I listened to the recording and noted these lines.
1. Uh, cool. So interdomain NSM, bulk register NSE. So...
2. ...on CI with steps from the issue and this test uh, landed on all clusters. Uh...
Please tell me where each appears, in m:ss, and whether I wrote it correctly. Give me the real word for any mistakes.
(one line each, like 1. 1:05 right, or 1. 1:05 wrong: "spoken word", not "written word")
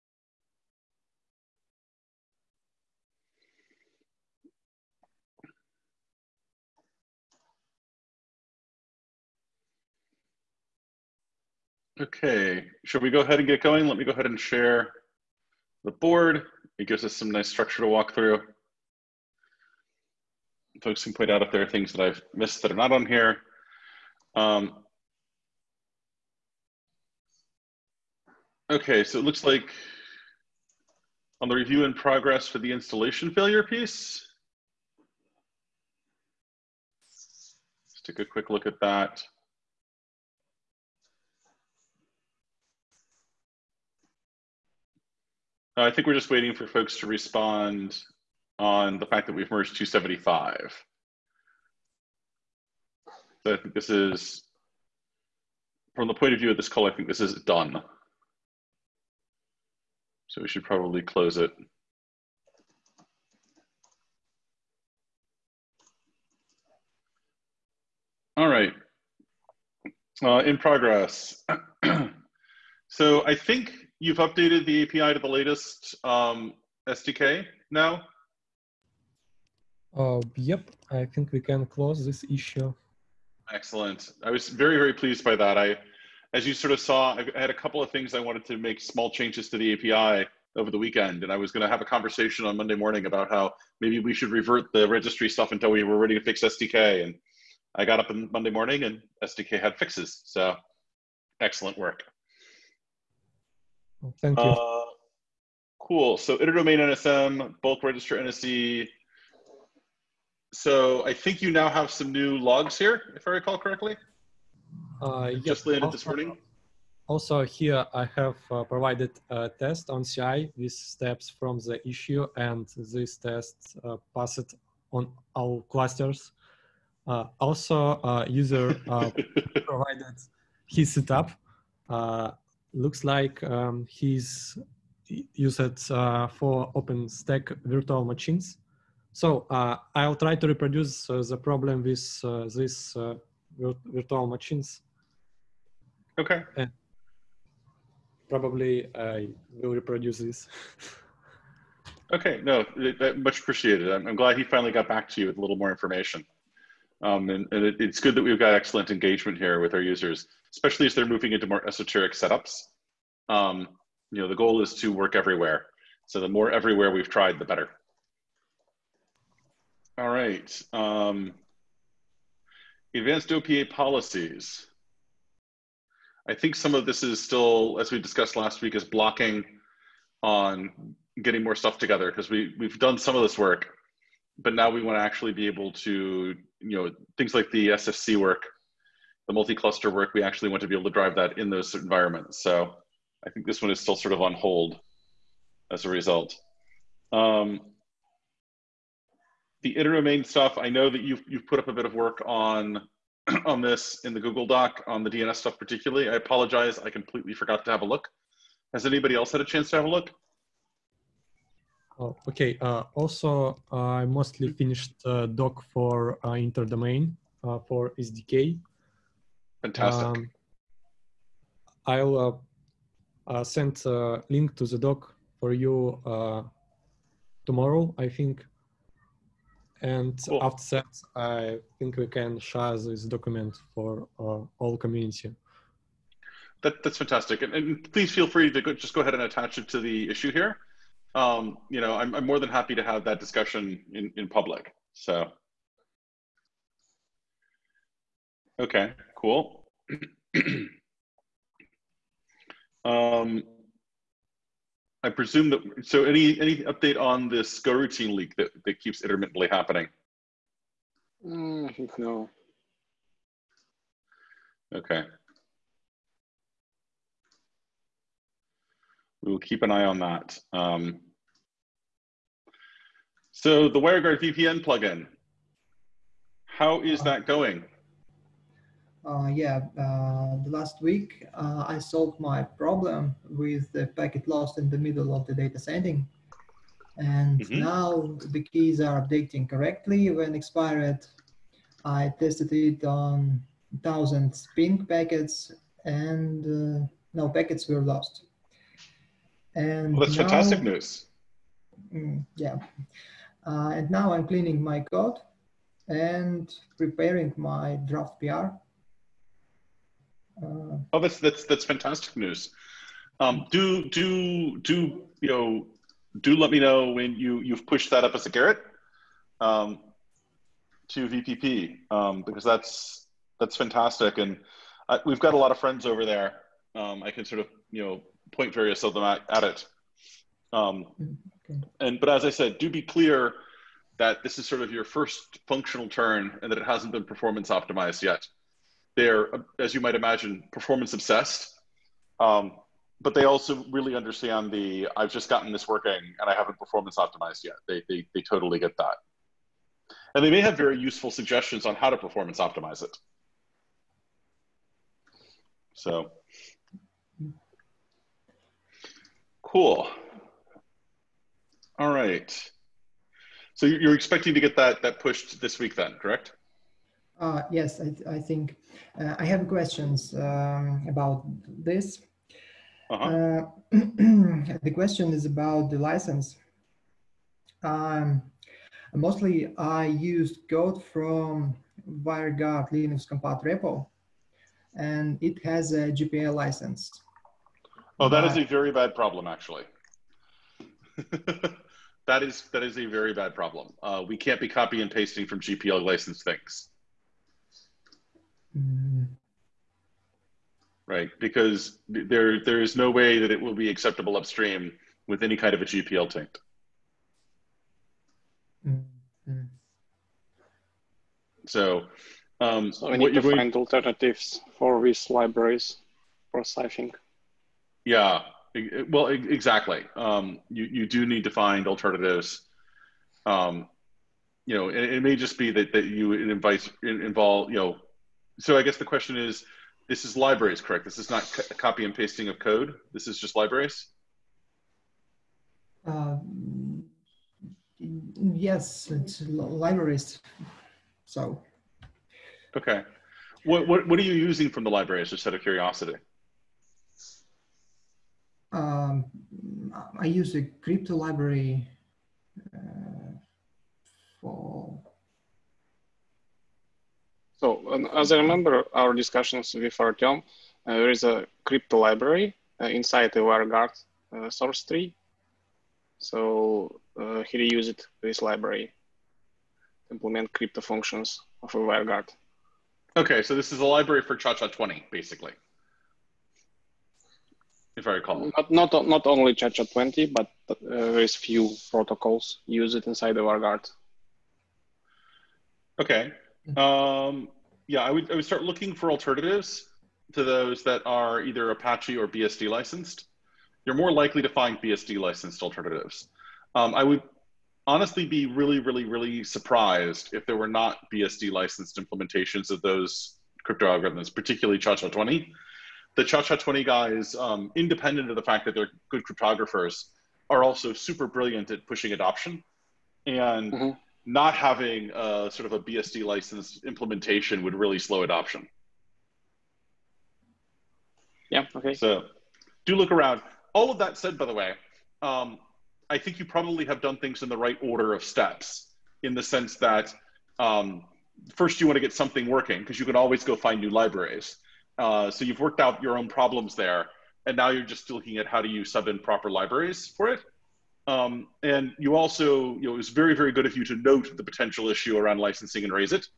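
1. 1:44 right
2. 1:59 wrong: "passed", not "landed".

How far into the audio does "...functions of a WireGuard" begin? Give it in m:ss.
7:50.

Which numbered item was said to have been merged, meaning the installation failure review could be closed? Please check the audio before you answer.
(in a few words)
275.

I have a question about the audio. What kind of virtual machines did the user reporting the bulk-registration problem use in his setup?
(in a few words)
OpenStack.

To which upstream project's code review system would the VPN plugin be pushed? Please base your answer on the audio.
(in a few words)
VPP.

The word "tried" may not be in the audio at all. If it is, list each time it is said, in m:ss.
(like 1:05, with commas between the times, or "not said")
2:47.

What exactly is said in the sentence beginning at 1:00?
So we should probably close it.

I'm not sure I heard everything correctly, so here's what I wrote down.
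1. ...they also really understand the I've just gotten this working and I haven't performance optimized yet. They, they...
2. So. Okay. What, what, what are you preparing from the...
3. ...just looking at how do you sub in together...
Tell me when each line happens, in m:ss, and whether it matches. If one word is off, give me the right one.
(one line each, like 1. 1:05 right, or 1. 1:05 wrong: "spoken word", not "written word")
1. 5:43 right
2. 7:21 wrong: "using", not "preparing"
3. 8:57 wrong: "proper", not "together".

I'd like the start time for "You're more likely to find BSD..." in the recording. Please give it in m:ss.
8:13.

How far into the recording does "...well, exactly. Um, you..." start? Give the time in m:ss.
6:58.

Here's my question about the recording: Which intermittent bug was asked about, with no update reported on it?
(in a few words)
Go routine leak.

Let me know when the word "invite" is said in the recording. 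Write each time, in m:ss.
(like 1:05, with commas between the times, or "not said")
7:06.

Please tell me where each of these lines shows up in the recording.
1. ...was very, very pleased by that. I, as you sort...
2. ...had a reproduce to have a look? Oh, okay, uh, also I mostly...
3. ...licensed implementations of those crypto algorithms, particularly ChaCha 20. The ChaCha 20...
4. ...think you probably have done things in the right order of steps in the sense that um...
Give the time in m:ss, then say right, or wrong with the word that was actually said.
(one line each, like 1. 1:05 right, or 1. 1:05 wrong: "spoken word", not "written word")
1. 1:24 right
2. 3:29 wrong: "chance", not "reproduce"
3. 8:21 right
4. 8:45 right.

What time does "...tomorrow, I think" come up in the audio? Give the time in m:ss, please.
3:47.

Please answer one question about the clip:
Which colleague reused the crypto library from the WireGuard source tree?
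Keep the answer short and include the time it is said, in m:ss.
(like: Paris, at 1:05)
Artyom, at 7:39.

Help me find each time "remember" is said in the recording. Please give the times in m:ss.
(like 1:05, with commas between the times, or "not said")
7:38.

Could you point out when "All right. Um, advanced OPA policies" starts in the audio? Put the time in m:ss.
2:49.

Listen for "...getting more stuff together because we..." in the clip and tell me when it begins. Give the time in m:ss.
3:01.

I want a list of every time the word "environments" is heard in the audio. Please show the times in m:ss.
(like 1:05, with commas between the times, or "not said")
3:11.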